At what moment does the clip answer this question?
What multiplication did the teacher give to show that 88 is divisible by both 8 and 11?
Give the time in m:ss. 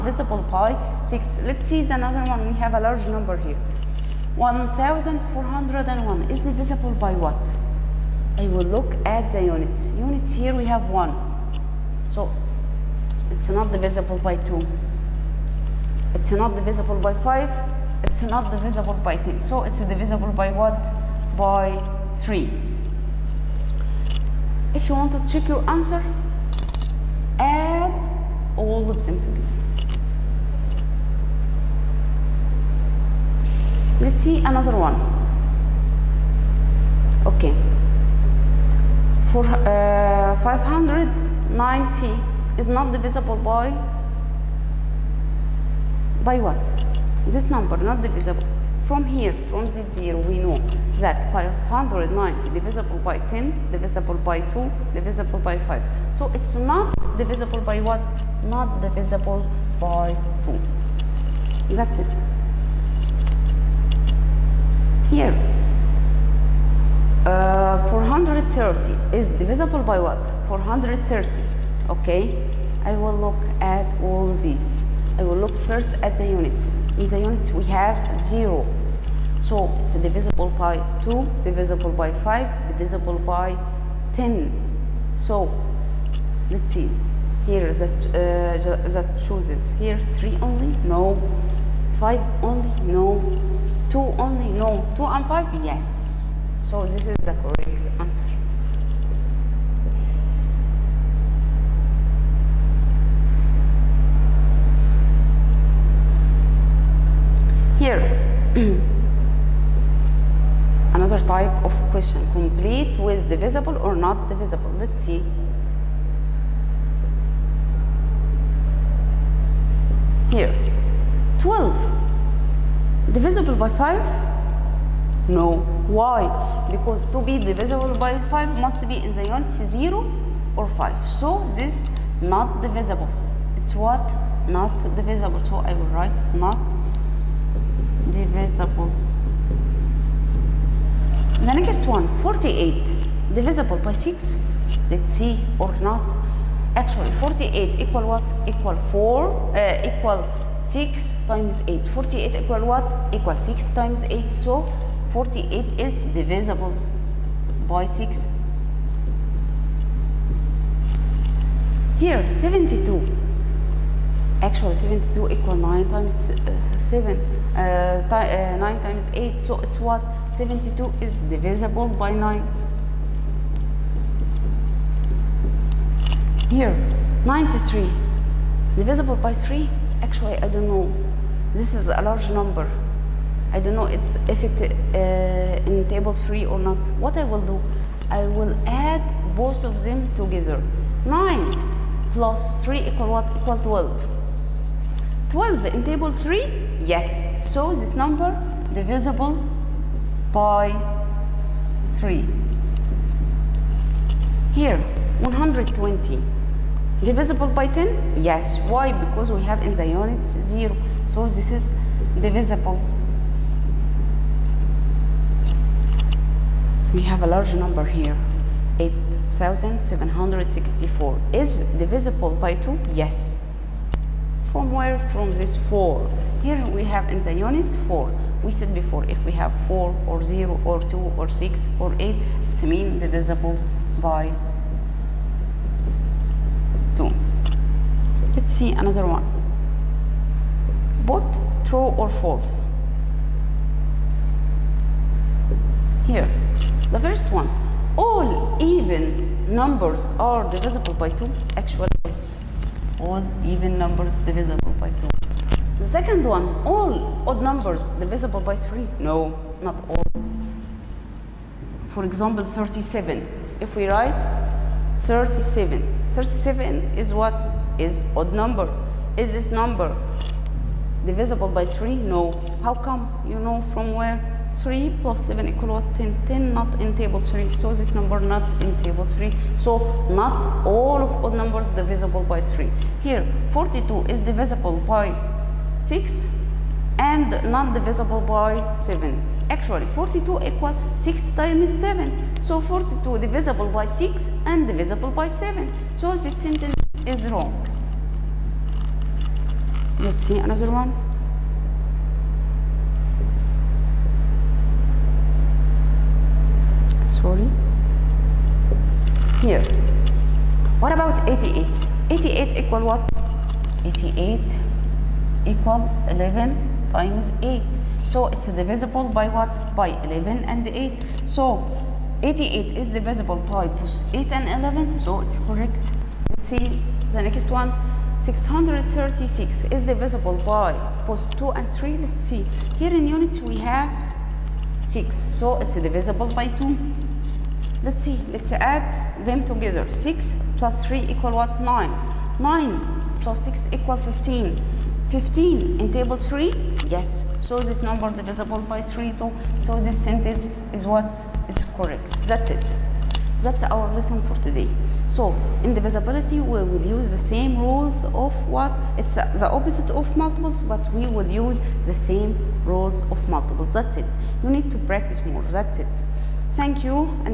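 5:16.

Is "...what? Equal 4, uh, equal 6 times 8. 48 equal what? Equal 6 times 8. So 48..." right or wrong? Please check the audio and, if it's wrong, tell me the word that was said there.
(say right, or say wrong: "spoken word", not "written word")
right.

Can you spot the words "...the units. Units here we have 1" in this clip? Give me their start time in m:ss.
0:09.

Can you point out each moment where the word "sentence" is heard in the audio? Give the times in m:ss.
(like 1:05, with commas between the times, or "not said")
4:56, 5:50.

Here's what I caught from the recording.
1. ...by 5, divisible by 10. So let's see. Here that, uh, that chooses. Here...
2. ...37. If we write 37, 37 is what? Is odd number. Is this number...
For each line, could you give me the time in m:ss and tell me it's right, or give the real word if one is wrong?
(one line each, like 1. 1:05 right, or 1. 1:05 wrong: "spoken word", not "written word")
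1. 1:21 right
2. 4:22 right.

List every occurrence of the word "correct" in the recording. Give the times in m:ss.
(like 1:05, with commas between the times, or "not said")
1:37, 5:25, 5:51.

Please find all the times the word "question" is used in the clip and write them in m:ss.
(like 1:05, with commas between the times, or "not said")
1:51.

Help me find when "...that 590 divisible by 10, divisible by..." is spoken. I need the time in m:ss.
0:50.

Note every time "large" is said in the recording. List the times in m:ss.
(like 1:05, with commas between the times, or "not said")
0:02, 3:02, 3:37.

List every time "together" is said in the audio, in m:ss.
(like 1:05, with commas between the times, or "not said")
0:29, 3:10, 5:39.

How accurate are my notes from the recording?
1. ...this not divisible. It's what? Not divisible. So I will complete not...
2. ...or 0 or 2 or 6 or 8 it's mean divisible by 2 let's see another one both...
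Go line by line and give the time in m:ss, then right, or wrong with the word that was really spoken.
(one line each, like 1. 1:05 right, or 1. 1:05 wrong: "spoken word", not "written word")
1. 2:11 wrong: "write", not "complete"
2. 3:50 right.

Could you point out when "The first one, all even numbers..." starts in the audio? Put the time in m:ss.
4:06.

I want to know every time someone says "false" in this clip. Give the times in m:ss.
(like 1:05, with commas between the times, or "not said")
4:02.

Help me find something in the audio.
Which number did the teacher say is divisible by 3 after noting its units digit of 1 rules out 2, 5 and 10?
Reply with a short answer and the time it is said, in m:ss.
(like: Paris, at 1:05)
1401, at 0:04.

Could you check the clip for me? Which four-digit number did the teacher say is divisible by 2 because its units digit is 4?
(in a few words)
8764.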